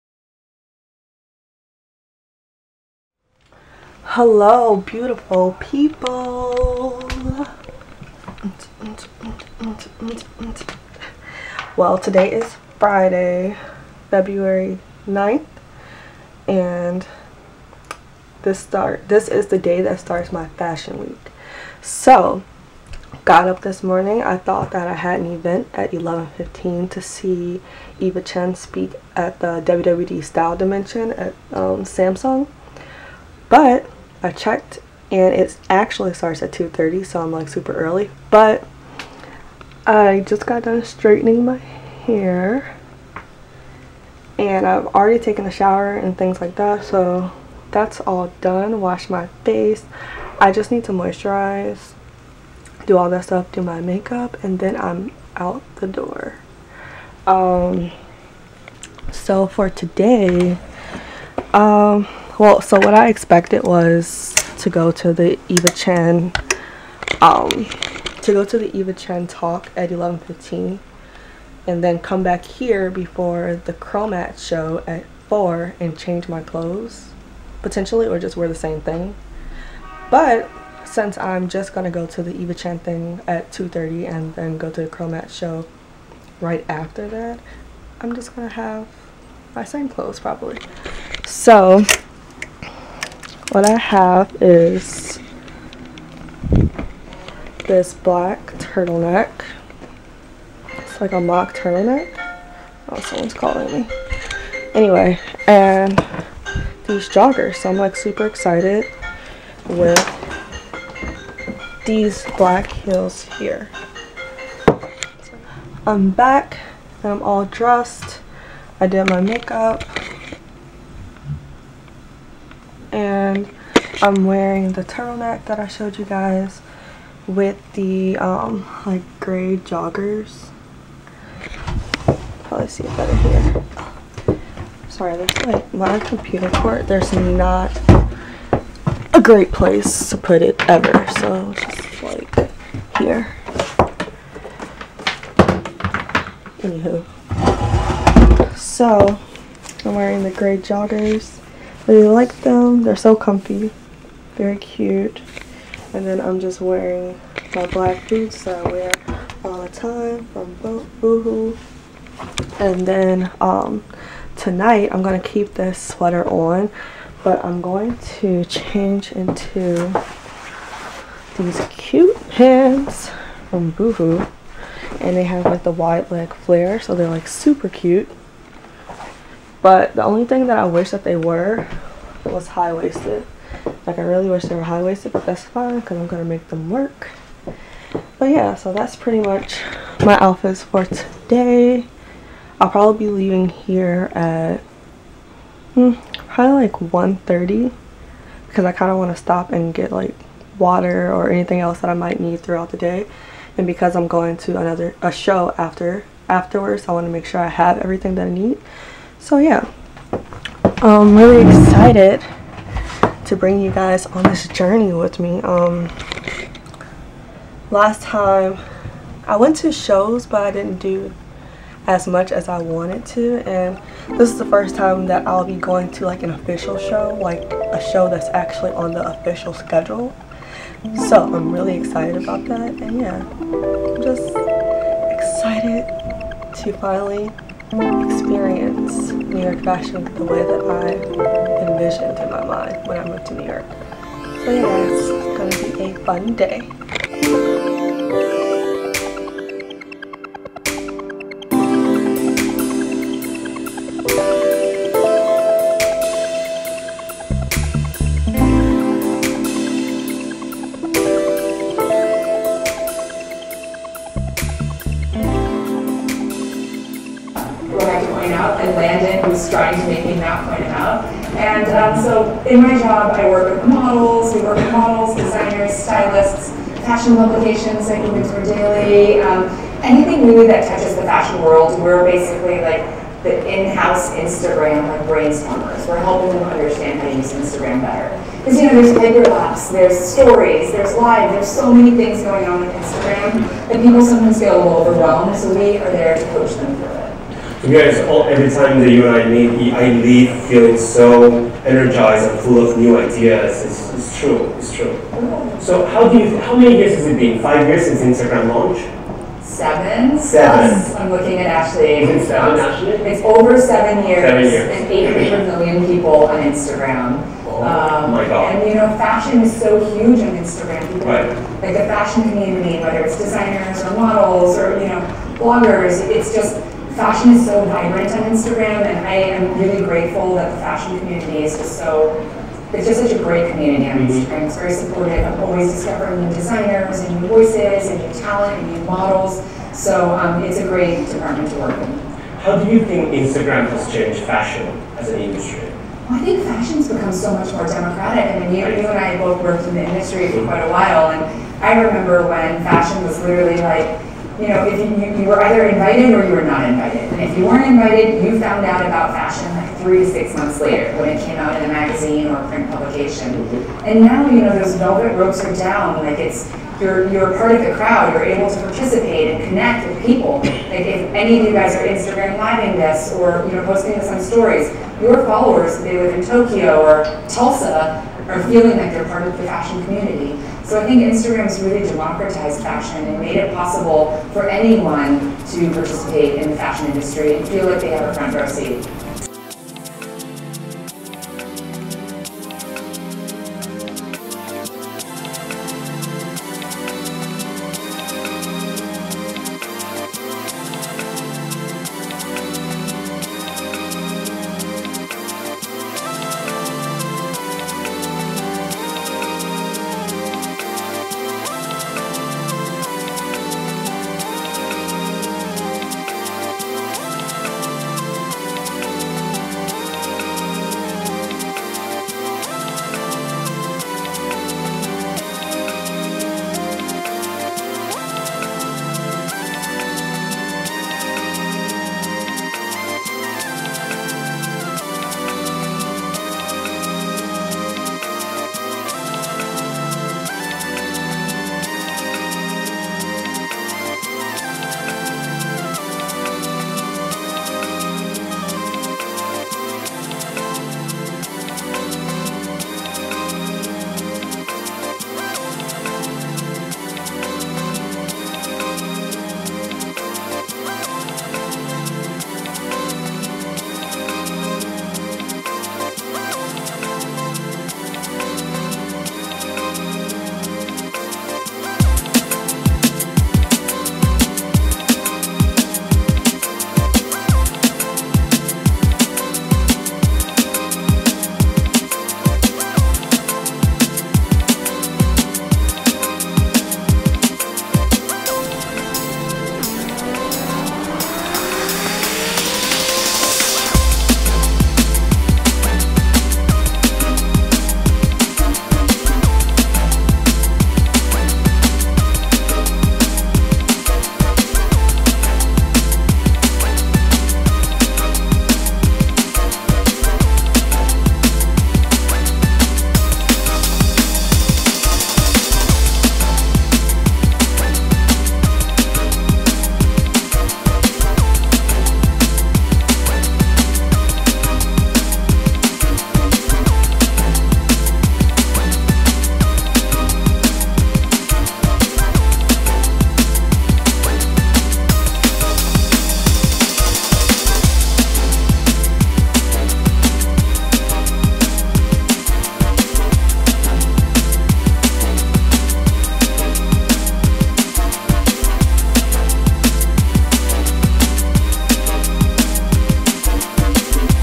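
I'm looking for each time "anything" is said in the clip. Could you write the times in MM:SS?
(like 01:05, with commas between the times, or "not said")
03:21, 04:39.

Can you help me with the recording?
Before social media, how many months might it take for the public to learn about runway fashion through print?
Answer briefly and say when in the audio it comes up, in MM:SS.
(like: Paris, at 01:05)
3 to 6 months, at 05:59.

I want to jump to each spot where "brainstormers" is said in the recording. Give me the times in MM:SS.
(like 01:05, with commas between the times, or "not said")
04:45.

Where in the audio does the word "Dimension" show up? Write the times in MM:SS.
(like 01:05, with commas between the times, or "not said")
00:30.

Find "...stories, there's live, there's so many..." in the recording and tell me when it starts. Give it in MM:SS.
04:49.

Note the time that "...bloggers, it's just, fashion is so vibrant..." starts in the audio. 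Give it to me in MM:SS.
05:25.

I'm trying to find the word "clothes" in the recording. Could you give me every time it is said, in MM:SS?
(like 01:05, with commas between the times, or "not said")
01:16, 01:29.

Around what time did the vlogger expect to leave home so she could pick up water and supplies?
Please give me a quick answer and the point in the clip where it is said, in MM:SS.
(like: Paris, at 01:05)
1:30, at 03:16.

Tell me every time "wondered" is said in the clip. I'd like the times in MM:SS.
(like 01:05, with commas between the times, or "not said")
not said.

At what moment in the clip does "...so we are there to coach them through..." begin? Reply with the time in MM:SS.
04:55.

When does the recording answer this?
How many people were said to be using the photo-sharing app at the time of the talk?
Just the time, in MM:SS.
05:15.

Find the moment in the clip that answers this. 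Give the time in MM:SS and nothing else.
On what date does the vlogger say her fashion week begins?
00:14.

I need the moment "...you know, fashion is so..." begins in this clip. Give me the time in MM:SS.
05:18.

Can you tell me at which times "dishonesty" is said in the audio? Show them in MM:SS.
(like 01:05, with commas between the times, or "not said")
not said.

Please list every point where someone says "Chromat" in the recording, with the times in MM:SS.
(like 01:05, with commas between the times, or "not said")
01:13, 01:24.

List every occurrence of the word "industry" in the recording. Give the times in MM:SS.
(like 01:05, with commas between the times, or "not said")
05:45, 05:49, 06:26.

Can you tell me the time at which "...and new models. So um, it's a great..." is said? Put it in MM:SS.
05:38.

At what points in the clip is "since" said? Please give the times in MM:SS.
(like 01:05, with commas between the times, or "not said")
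01:20, 05:07.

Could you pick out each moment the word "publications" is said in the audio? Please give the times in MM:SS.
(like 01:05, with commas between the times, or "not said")
04:37, 06:02.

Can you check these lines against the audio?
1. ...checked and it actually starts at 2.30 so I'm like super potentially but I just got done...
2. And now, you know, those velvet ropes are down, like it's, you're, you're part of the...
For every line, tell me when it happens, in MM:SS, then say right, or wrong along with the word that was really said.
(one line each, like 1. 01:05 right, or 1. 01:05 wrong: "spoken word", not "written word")
1. 00:34 wrong: "early", not "potentially"
2. 06:03 right.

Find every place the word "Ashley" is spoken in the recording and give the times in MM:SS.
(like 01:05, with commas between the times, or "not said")
05:11.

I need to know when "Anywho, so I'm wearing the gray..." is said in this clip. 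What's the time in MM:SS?
02:26.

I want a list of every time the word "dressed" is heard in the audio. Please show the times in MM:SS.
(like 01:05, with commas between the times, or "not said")
01:57.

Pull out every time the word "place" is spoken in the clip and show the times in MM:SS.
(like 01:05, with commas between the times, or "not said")
02:19.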